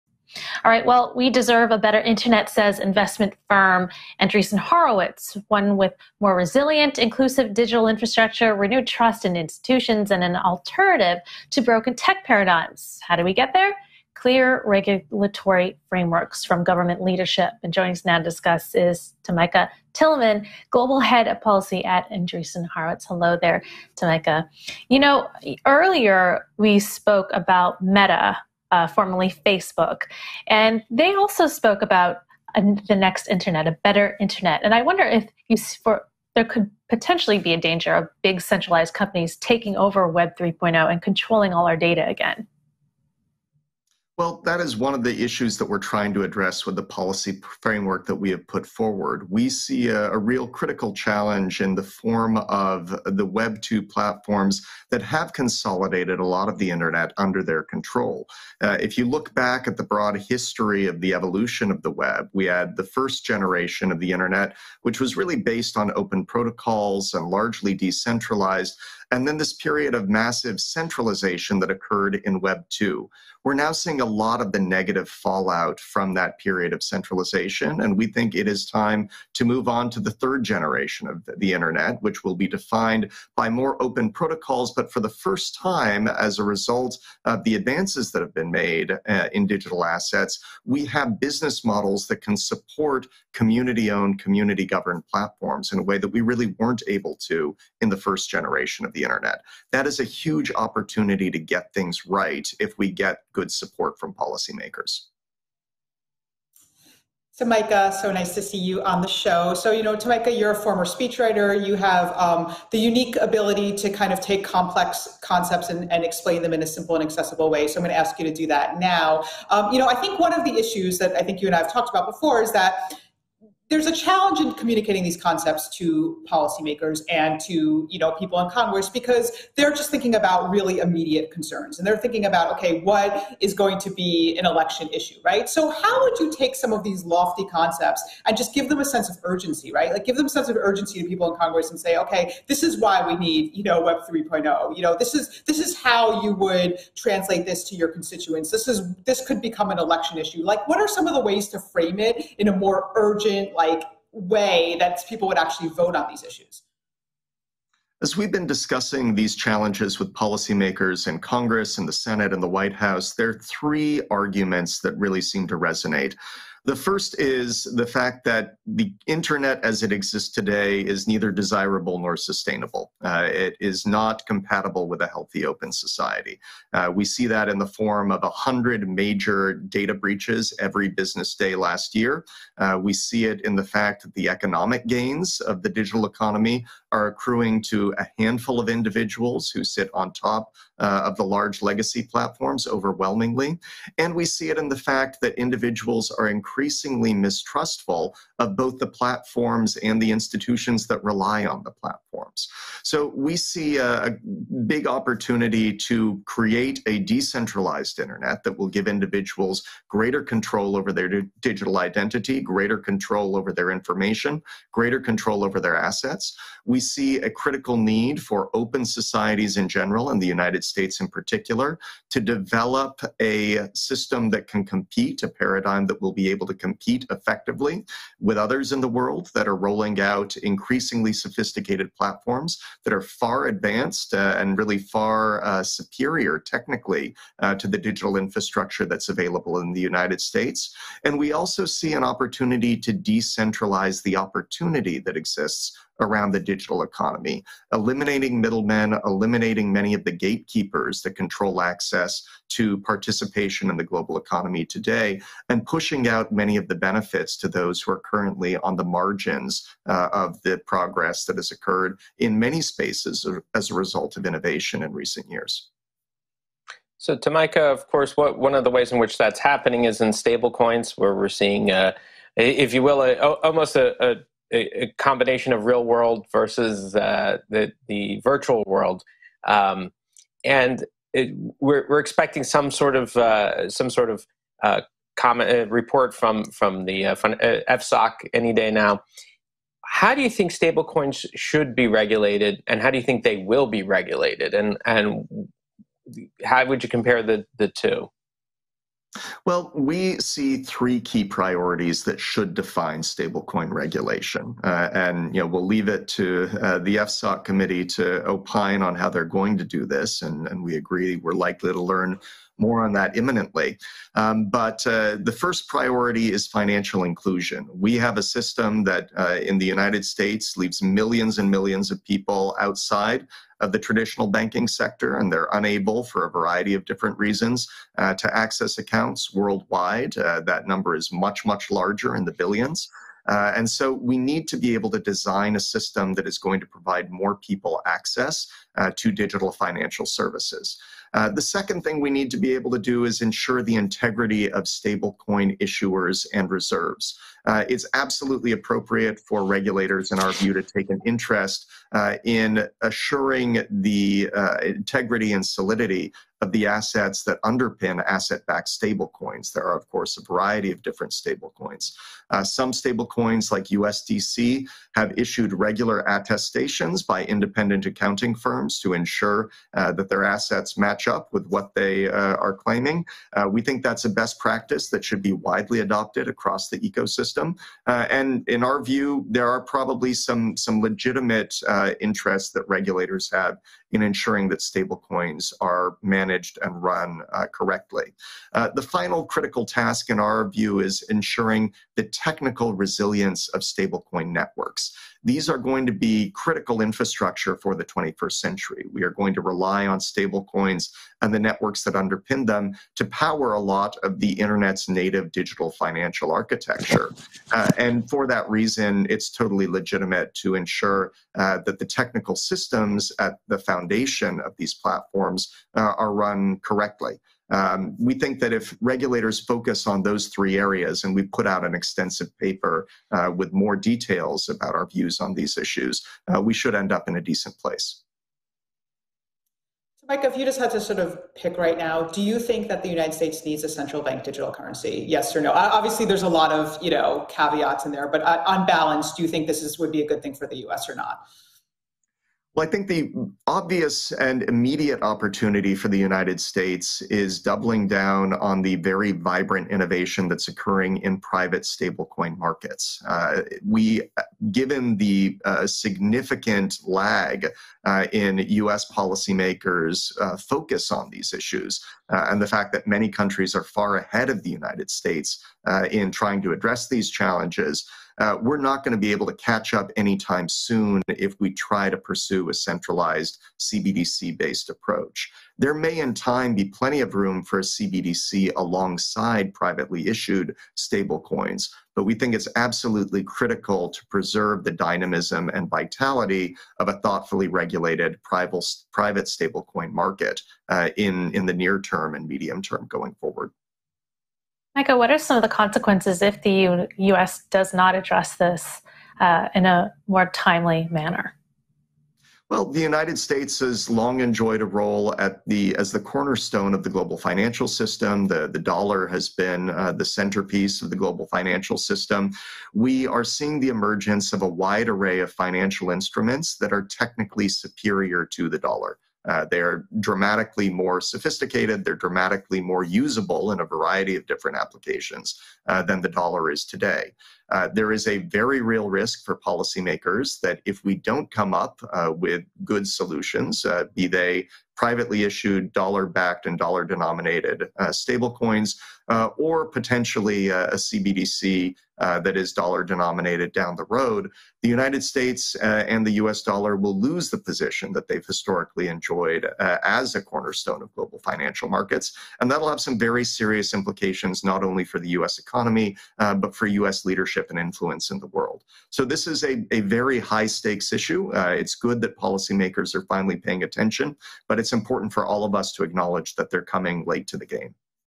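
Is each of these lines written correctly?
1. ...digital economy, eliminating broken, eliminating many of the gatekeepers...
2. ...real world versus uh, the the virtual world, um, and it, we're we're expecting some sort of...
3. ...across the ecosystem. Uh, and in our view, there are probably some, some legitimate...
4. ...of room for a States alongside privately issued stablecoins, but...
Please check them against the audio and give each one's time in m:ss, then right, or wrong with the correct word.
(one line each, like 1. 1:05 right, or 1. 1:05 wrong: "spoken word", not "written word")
1. 4:06 wrong: "middlemen", not "broken"
2. 4:35 right
3. 6:16 right
4. 7:57 wrong: "CBDC", not "States".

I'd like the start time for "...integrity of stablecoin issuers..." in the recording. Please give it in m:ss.
5:43.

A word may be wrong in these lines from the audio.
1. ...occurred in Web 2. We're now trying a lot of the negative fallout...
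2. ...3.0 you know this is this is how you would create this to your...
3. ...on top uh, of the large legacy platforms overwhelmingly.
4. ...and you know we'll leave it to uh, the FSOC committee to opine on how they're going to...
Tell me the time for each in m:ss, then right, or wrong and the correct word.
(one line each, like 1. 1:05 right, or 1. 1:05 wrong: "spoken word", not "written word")
1. 1:11 wrong: "seeing", not "trying"
2. 2:24 wrong: "translate", not "create"
3. 3:09 right
4. 5:04 right.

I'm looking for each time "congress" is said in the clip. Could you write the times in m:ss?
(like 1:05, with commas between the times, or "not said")
2:08, 2:21, 2:41.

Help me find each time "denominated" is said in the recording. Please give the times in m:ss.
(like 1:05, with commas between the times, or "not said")
8:56, 9:02.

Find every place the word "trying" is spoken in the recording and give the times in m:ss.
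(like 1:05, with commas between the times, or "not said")
0:45, 7:46.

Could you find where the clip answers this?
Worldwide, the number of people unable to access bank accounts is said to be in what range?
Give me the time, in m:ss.
5:32.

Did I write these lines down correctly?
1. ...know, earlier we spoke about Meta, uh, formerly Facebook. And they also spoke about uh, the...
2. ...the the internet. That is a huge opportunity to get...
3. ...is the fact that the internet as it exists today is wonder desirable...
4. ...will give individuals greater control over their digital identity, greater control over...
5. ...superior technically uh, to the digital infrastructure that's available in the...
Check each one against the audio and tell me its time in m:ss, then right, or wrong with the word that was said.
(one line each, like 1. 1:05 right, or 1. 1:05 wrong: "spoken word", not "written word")
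1. 0:24 right
2. 1:38 right
3. 2:47 wrong: "neither", not "wonder"
4. 3:28 right
5. 3:55 right.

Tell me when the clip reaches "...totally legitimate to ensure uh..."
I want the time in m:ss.
6:49.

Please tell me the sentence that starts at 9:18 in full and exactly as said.
So this is a, a very high stakes issue.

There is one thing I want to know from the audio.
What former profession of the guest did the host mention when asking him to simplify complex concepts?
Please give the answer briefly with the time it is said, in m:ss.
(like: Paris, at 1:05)
speechwriter, at 1:50.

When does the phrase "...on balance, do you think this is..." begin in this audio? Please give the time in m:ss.
7:18.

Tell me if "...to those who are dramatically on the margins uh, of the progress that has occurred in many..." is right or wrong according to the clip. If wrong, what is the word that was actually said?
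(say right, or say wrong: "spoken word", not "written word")
wrong: "currently", not "dramatically".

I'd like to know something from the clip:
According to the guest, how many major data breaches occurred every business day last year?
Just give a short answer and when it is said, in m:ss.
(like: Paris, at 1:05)
100, at 2:58.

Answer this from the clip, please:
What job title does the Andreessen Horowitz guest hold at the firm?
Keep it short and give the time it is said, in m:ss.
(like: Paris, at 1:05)
Global Head of Policy, at 0:20.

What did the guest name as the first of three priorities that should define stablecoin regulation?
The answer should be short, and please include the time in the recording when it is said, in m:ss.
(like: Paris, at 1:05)
financial inclusion, at 5:16.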